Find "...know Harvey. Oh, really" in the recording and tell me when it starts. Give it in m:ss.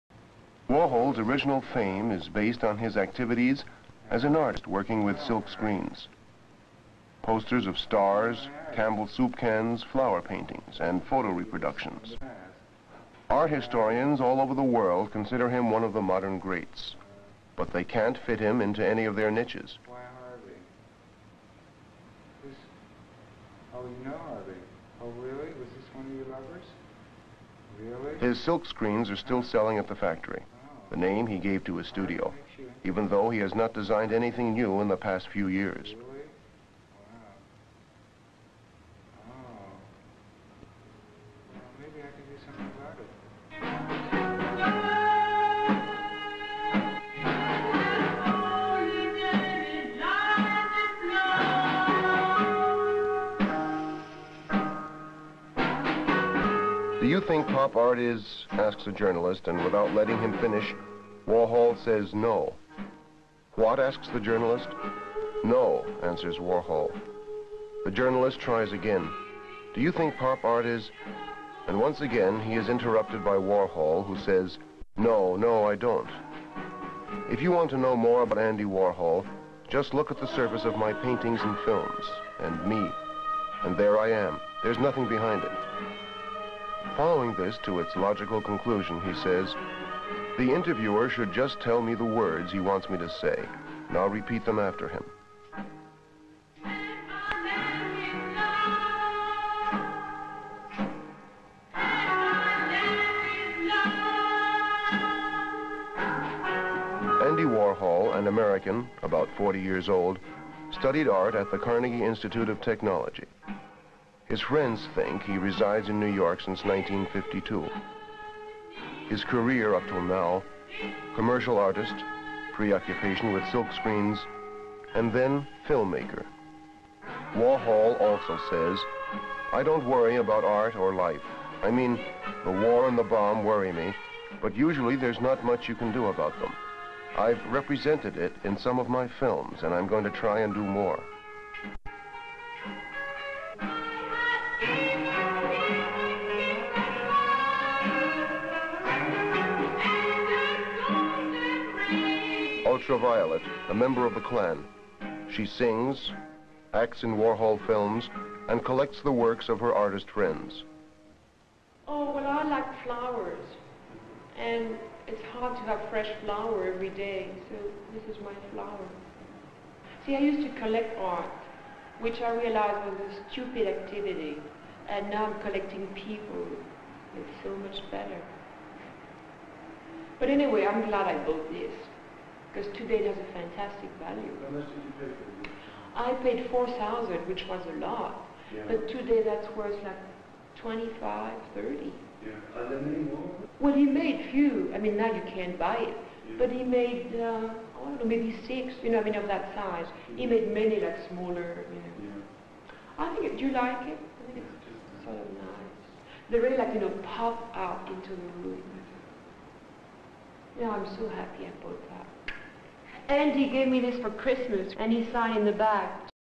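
0:24.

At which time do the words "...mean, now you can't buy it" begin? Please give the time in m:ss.
3:14.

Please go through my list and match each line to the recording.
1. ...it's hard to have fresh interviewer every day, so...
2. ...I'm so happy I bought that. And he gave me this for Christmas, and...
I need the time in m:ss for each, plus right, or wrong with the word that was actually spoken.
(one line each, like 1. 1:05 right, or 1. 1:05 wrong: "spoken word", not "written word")
1. 2:45 wrong: "flower", not "interviewer"
2. 3:30 right.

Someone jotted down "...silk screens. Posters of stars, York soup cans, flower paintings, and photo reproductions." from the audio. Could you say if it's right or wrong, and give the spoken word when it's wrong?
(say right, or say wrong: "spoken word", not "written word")
wrong: "Campbell", not "York".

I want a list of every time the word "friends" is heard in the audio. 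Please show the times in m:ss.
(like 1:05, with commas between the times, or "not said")
1:54, 2:40.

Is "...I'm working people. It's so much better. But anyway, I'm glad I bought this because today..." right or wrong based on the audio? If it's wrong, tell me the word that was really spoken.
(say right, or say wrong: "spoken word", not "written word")
wrong: "collecting", not "working".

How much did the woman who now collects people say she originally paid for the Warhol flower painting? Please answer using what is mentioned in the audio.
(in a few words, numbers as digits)
4000.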